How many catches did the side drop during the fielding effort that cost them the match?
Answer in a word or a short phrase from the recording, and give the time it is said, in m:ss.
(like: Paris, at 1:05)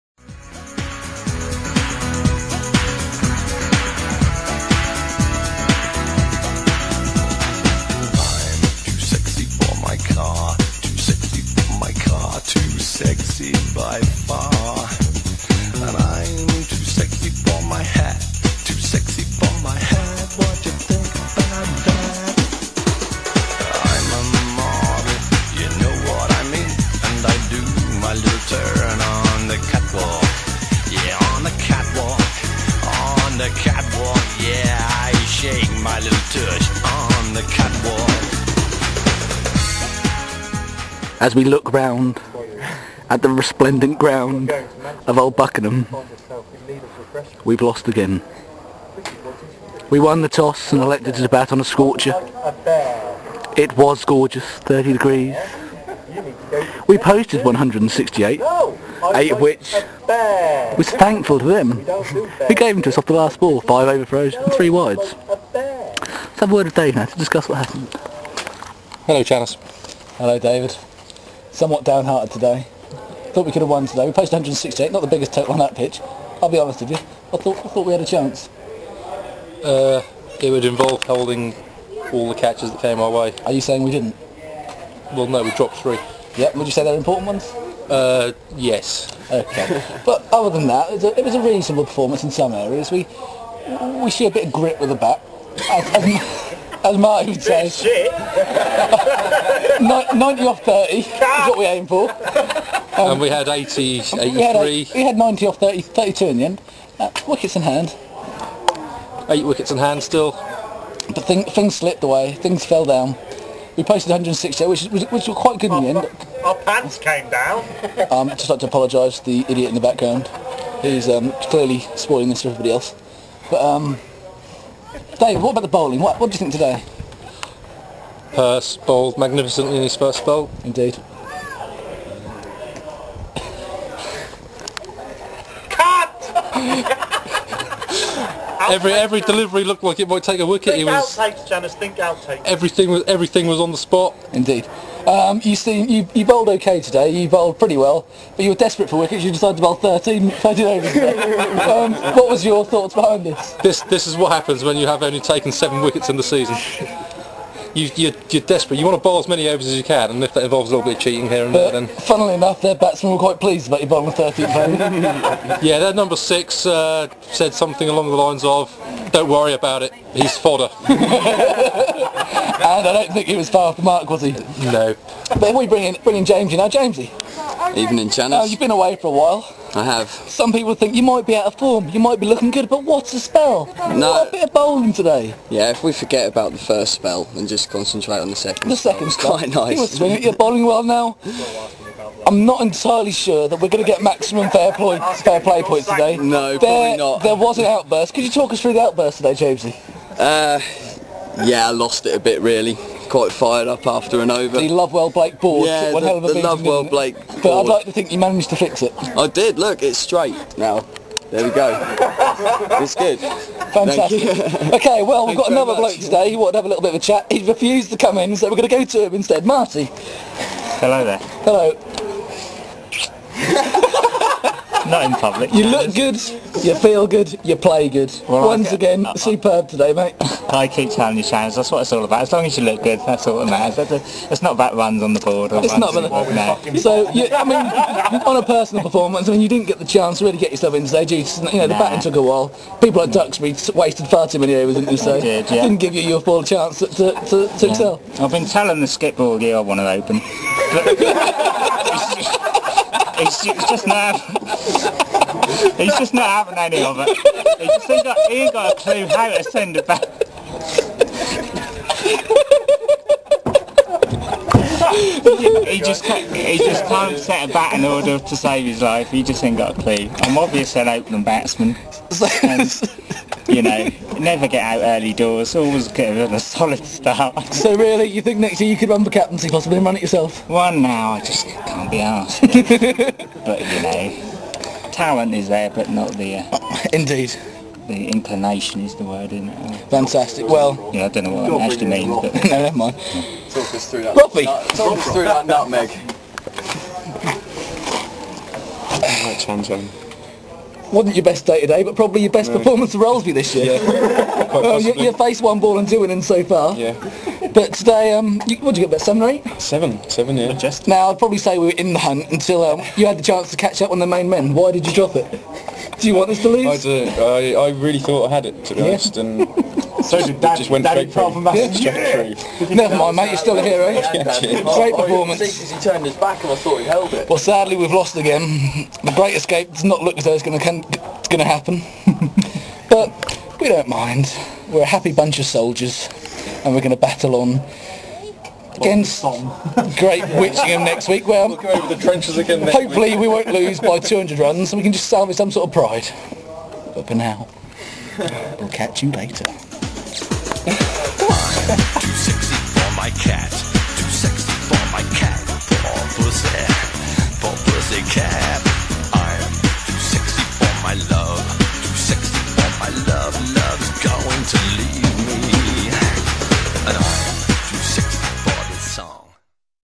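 3, at 1:25.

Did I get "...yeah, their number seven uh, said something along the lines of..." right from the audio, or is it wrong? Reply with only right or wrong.
wrong.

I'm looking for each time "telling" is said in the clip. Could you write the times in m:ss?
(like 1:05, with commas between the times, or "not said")
3:50, 4:08.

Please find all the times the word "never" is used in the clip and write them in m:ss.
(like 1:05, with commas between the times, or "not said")
4:34, 4:52, 5:22.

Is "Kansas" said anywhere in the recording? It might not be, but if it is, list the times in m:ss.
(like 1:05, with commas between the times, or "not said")
not said.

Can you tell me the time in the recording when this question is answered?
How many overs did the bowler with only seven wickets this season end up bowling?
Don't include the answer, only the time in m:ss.
2:30.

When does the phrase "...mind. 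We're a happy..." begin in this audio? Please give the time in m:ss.
5:33.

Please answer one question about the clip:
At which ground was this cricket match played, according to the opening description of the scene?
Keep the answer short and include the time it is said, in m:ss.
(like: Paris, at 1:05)
Old Buckenham, at 0:45.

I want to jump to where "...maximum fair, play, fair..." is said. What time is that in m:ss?
3:14.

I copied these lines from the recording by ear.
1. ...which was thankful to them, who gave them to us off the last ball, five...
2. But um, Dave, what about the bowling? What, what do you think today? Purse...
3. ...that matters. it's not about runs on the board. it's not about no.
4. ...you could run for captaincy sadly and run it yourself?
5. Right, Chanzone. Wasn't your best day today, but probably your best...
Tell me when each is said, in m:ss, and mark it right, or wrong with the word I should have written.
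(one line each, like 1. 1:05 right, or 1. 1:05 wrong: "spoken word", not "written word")
1. 0:59 right
2. 2:03 right
3. 3:53 right
4. 4:38 wrong: "possibly", not "sadly"
5. 4:59 right.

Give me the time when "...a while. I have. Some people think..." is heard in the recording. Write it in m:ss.
2:59.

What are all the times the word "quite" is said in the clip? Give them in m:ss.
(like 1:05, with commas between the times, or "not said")
1:55, 2:43, 3:09, 3:23.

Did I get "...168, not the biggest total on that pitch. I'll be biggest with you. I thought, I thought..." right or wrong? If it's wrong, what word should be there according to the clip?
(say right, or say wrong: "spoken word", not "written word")
wrong: "honest", not "biggest".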